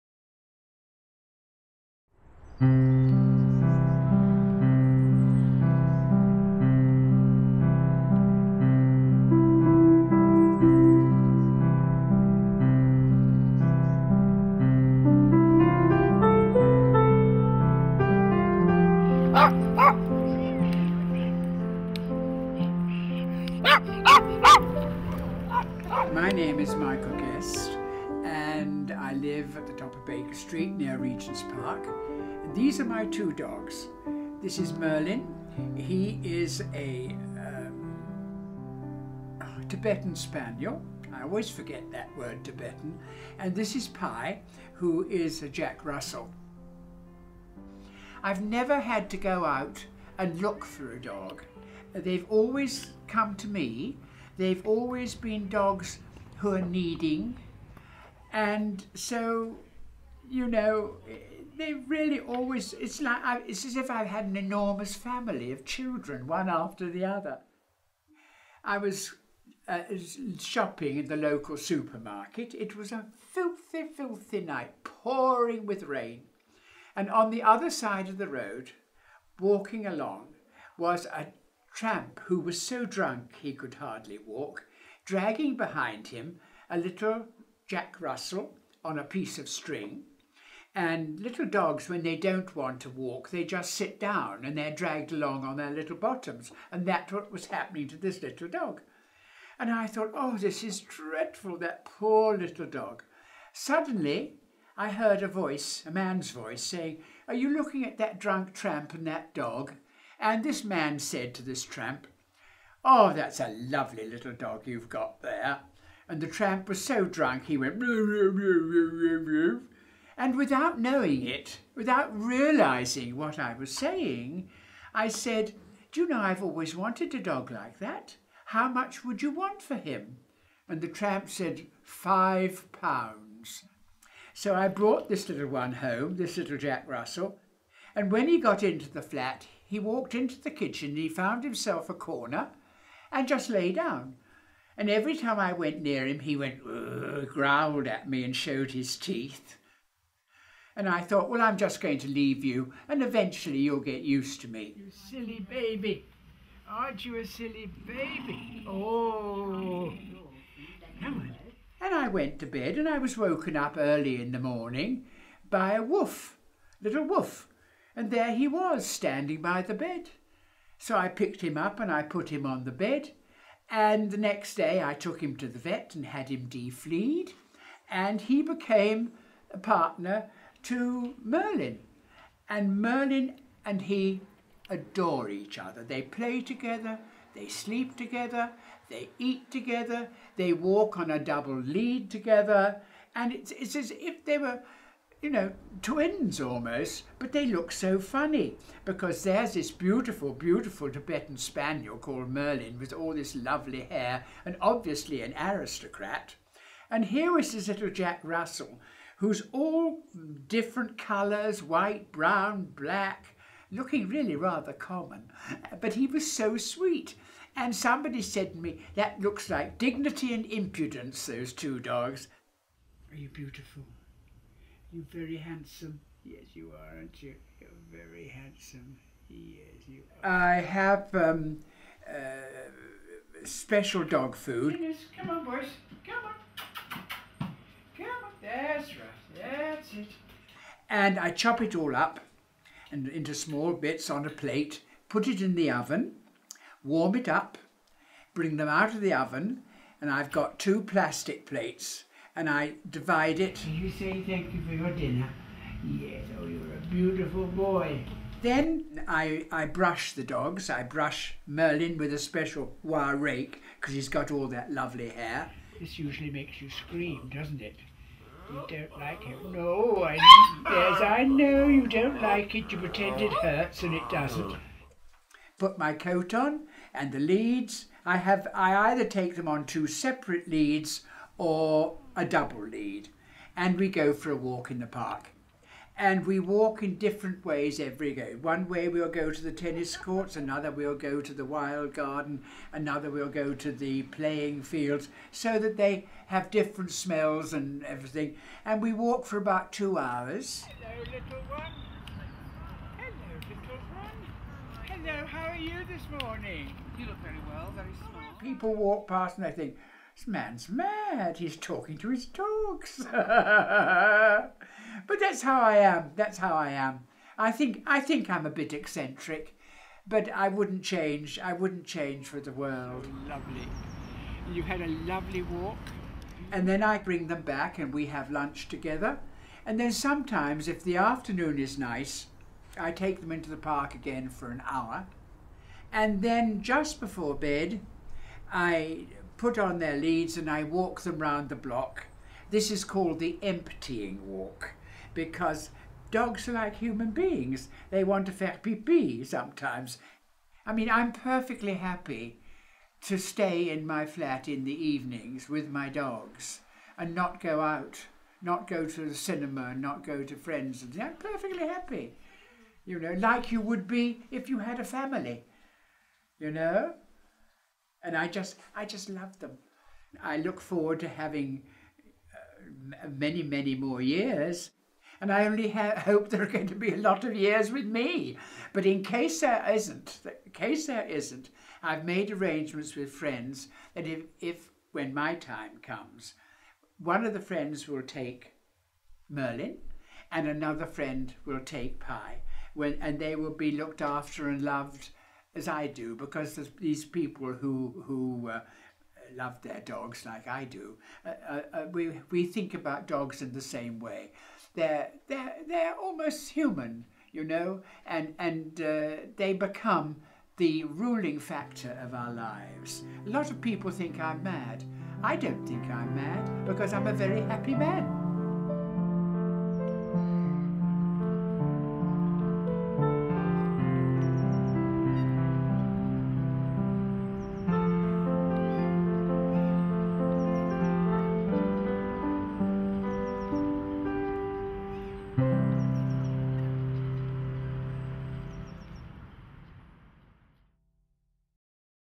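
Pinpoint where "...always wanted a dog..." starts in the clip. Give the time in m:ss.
2:06.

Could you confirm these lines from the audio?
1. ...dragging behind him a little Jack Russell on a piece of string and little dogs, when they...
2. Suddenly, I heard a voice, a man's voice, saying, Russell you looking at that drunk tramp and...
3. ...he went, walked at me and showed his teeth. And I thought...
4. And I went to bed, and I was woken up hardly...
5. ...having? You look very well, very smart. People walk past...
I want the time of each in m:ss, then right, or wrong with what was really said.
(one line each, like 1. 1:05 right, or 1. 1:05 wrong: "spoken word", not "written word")
1. 1:25 right
2. 1:43 wrong: "Are", not "Russell"
3. 2:26 wrong: "growled", not "walked"
4. 2:41 wrong: "early", not "hardly"
5. 5:06 wrong: "morning", not "having".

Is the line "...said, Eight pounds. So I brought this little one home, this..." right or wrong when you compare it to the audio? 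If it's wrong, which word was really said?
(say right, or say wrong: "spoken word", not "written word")
wrong: "Five", not "Eight".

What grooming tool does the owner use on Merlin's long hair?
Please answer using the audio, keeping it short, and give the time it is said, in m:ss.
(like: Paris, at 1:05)
wire rake, at 4:22.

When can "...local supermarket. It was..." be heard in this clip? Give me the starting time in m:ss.
1:11.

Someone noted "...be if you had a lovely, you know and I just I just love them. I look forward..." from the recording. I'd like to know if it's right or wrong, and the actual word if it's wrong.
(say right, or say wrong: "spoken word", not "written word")
wrong: "family", not "lovely".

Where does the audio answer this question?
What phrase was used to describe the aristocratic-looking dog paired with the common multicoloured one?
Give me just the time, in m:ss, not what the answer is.
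3:39.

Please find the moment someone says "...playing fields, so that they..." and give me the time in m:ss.
4:54.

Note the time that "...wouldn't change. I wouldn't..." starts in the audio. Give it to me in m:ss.
5:20.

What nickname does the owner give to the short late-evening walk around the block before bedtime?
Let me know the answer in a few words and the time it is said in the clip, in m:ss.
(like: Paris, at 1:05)
the emptying walk, at 5:43.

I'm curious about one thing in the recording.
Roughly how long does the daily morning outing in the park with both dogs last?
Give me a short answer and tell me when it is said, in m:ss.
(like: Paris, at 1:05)
2 hours, at 4:59.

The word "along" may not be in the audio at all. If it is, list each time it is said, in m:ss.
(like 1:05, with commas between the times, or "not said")
1:19, 1:35.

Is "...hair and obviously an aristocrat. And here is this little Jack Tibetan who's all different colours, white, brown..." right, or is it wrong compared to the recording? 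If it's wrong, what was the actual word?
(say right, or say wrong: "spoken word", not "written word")
wrong: "Russell", not "Tibetan".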